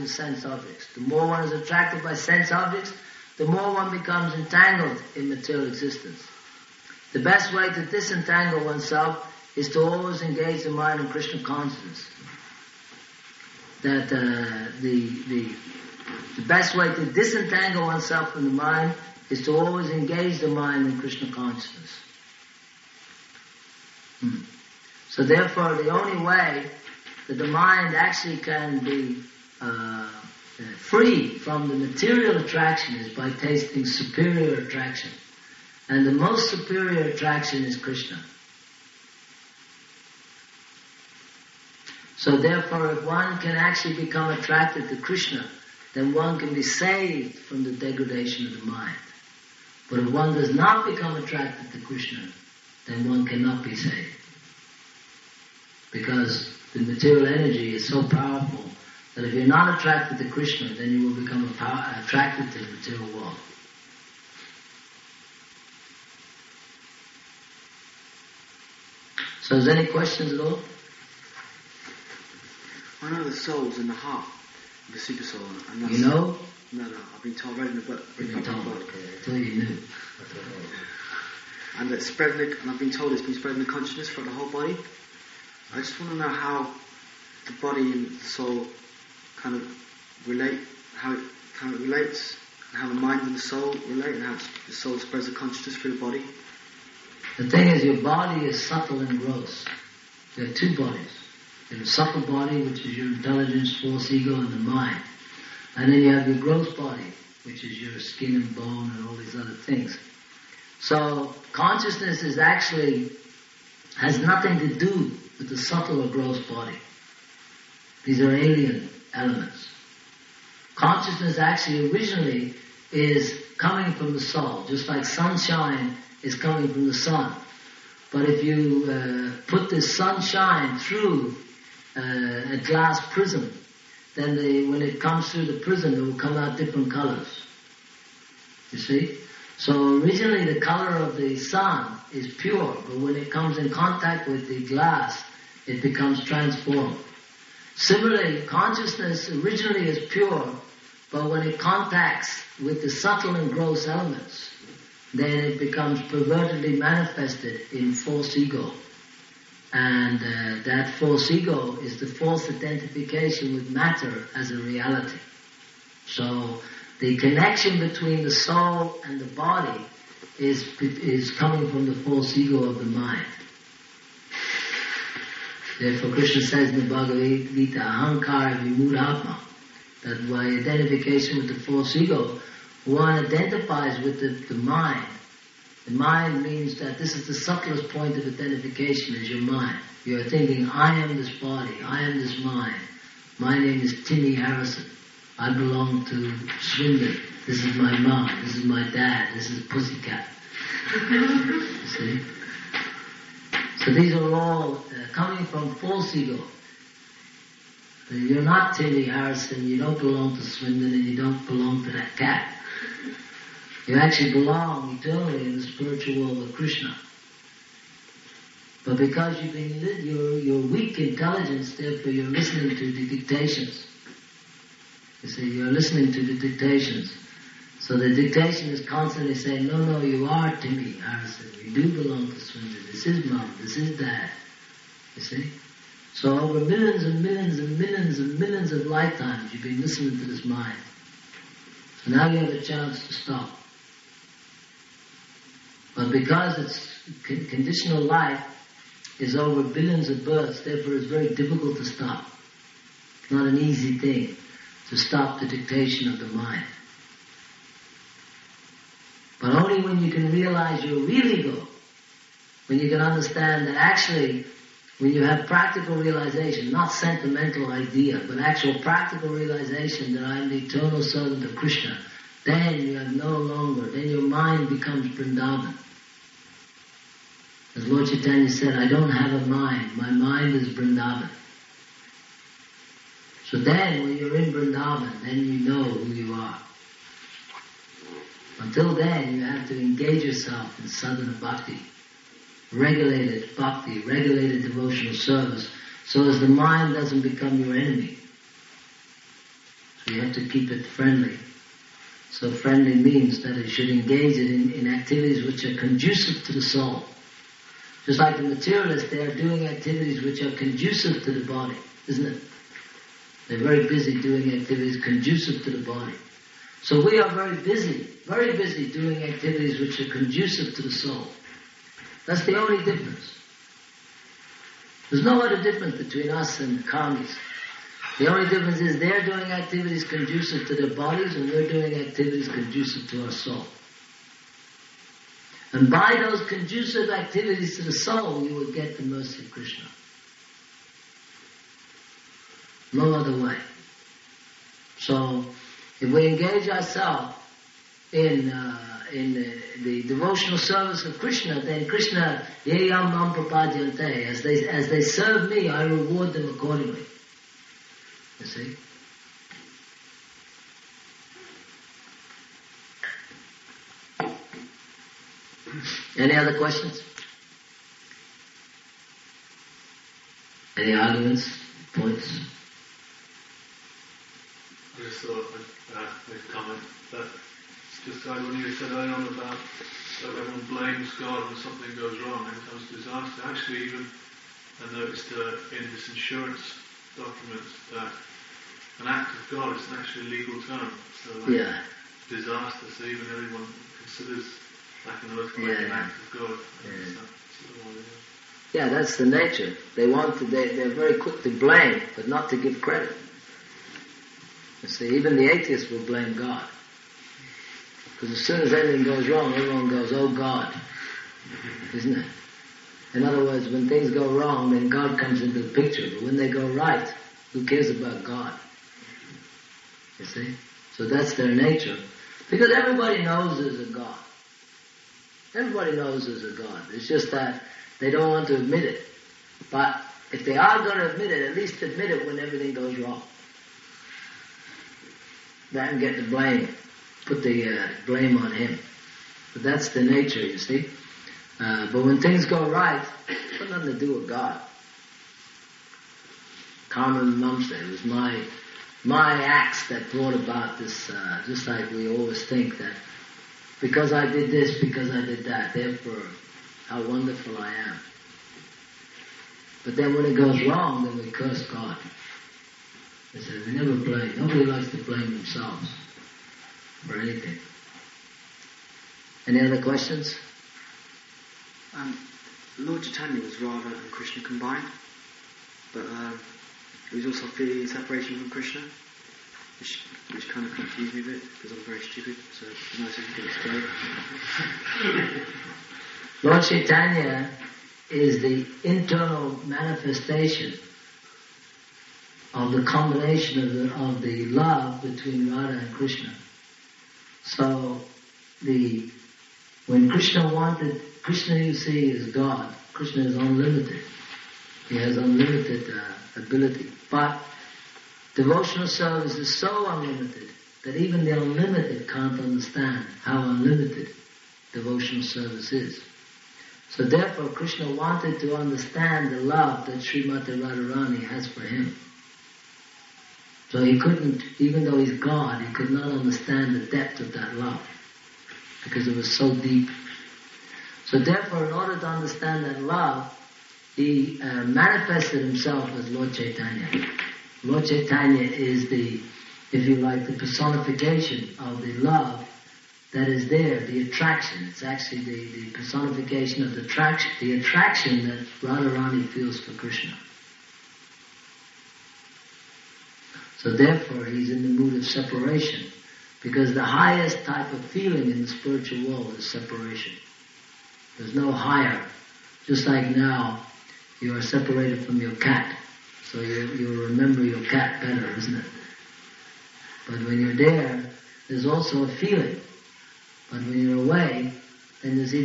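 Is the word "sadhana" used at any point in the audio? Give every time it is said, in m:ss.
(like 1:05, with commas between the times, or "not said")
4:50.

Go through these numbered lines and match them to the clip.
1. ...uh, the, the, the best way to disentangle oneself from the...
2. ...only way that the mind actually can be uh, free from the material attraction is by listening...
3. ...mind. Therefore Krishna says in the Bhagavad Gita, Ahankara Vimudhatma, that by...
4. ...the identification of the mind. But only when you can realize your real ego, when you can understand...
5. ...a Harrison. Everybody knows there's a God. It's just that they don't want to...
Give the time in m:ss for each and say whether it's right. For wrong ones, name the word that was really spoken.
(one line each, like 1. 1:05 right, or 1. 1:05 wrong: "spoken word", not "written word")
1. 0:14 right
2. 0:25 wrong: "tasting", not "listening"
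3. 2:52 right
4. 4:15 wrong: "dictation", not "identification"
5. 7:03 wrong: "God", not "Harrison".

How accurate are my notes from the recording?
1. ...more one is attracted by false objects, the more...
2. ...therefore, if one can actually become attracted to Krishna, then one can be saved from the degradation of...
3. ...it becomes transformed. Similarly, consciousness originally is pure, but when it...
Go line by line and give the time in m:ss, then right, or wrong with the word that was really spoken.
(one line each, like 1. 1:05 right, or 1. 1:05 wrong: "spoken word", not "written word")
1. 0:01 wrong: "sense", not "false"
2. 0:42 right
3. 2:25 right.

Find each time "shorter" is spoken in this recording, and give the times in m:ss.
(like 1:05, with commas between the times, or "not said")
not said.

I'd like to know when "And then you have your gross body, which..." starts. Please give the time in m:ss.
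1:45.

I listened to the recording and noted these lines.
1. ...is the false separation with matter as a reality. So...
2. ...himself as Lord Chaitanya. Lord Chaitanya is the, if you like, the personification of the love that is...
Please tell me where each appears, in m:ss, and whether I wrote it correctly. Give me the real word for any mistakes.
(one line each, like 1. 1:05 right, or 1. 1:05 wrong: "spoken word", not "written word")
1. 2:41 wrong: "identification", not "separation"
2. 8:55 right.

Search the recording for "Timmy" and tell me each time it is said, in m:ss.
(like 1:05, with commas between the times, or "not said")
3:14.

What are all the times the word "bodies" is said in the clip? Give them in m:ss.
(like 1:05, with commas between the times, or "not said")
1:40, 5:30.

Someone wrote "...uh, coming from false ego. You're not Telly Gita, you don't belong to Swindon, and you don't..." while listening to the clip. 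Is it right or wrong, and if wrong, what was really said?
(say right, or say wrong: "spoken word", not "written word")
wrong: "Harrison", not "Gita".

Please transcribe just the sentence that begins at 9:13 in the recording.
So therefore, he's in the mood of separation.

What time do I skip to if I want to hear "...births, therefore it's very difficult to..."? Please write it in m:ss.
4:10.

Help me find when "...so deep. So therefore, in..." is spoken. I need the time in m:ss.
8:49.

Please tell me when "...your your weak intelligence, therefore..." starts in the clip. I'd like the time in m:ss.
3:40.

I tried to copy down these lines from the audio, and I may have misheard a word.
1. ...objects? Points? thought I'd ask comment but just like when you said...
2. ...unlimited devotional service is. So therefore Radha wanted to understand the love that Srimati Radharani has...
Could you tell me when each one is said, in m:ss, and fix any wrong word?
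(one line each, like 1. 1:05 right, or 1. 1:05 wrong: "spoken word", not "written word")
1. 6:10 wrong: "arguments", not "objects"
2. 8:33 wrong: "Krishna", not "Radha".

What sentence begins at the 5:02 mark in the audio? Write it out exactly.
So friendly means that it should engage it in, in activities which are conducive to the soul.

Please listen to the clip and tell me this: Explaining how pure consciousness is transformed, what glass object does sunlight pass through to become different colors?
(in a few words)
glass prism.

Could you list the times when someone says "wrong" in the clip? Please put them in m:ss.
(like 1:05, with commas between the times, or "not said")
6:22, 6:49, 6:54, 7:12, 7:40.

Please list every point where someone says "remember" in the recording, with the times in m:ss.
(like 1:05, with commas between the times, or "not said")
9:27.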